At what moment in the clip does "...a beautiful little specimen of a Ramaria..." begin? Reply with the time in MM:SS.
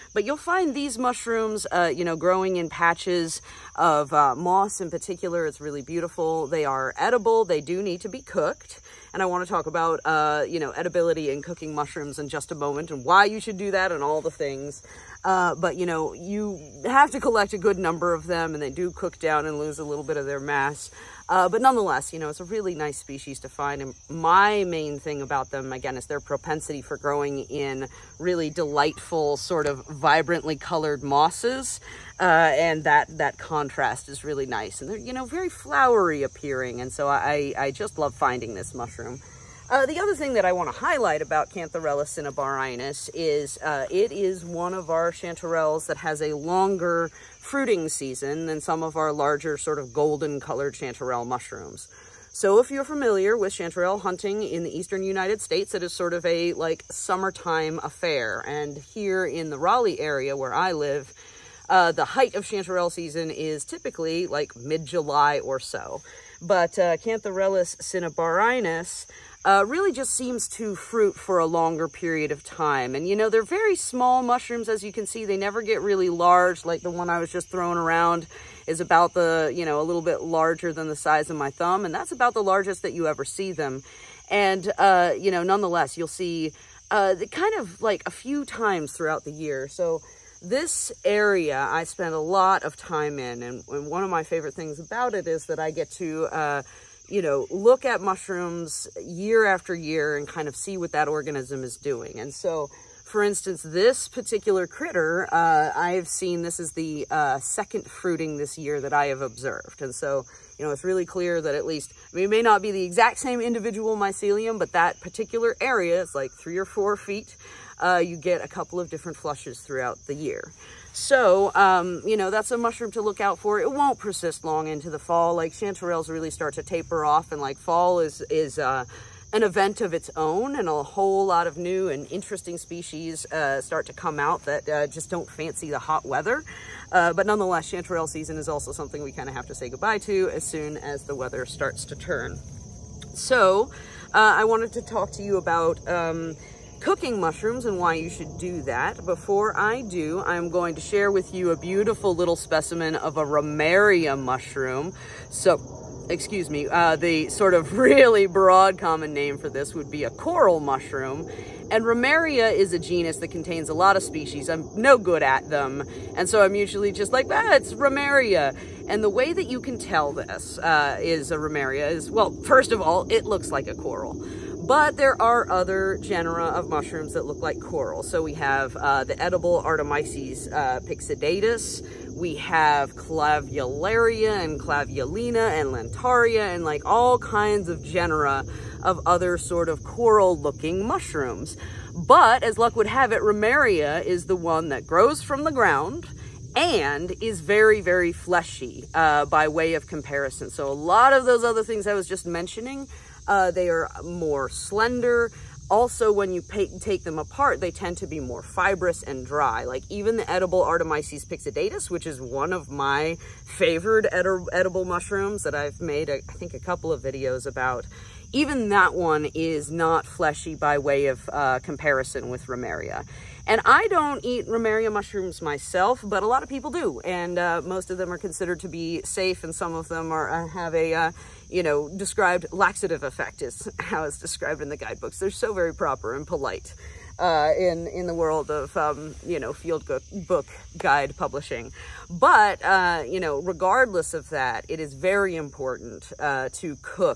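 02:31.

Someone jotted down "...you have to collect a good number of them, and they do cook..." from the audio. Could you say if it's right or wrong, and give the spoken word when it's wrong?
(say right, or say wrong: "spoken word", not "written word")
right.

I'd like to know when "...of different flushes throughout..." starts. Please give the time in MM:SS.
01:58.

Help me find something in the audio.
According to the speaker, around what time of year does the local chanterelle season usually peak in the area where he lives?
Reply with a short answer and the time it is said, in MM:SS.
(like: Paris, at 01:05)
mid-July, at 01:04.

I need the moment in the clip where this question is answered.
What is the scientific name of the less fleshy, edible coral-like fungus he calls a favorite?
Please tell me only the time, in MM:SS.
03:30.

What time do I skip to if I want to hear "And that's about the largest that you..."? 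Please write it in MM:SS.
01:21.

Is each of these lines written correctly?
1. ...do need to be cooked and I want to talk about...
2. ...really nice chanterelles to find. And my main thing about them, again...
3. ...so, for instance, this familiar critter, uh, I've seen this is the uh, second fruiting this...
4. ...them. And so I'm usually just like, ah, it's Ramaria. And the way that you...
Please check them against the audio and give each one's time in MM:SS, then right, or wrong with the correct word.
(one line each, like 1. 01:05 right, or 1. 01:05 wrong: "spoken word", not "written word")
1. 00:07 right
2. 00:22 wrong: "species", not "chanterelles"
3. 01:42 wrong: "particular", not "familiar"
4. 02:45 right.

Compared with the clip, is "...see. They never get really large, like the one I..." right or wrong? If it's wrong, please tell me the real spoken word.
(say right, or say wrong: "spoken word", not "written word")
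right.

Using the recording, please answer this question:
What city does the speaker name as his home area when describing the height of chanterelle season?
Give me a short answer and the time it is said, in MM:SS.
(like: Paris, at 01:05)
Raleigh, at 00:59.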